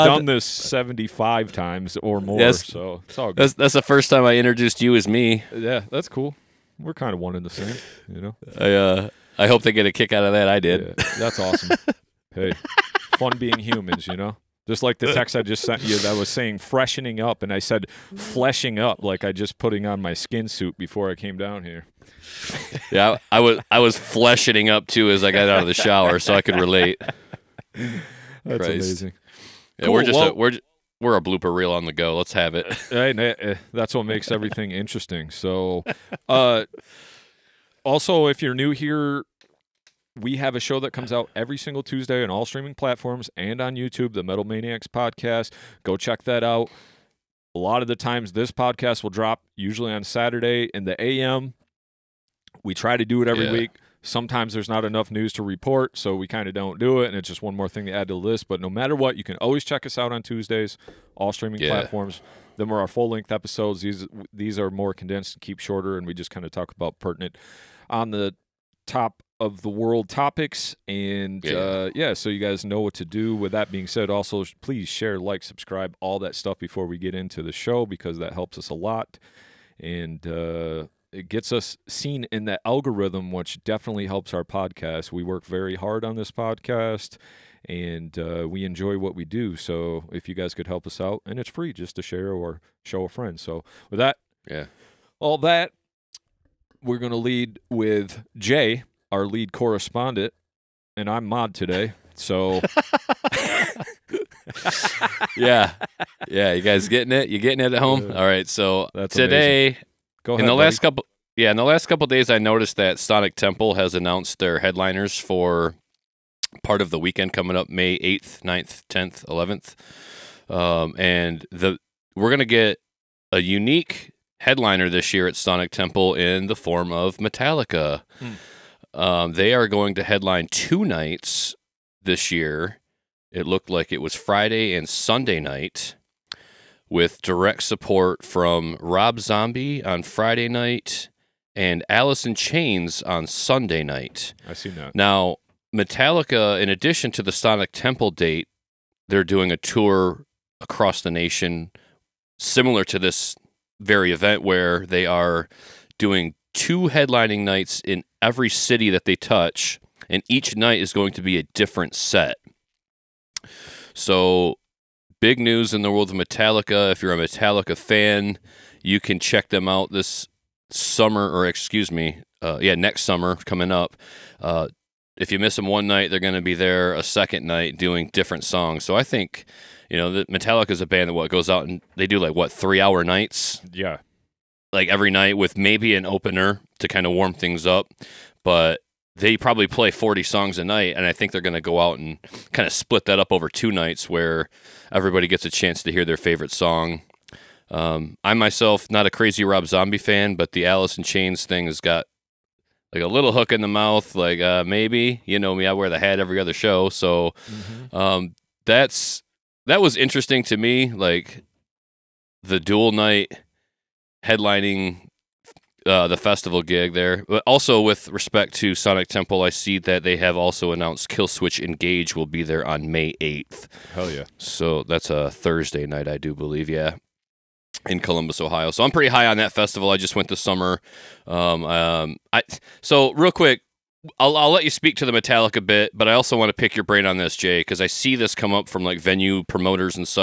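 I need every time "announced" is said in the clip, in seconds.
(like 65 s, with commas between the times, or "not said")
113 s, 220 s.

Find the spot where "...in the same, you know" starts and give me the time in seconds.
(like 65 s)
7 s.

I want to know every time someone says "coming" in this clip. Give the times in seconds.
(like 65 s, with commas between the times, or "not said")
117 s, 173 s.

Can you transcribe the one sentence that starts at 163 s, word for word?
So, big news in the world of Metallica.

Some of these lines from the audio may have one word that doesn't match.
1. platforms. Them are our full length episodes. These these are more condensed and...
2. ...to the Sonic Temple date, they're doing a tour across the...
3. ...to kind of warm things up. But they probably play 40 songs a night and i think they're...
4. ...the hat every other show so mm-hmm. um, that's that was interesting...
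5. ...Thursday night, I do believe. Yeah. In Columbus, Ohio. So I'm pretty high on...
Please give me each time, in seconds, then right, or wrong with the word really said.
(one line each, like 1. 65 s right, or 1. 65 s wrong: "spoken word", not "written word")
1. 61 s right
2. 147 s right
3. 186 s right
4. 205 s right
5. 225 s right.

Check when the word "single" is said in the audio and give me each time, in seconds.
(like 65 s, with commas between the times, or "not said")
41 s.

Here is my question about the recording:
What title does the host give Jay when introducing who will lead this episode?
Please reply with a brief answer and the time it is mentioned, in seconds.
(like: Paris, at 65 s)
lead correspondent, at 99 s.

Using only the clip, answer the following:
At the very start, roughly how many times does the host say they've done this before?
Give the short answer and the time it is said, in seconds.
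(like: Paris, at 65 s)
75, at 0 s.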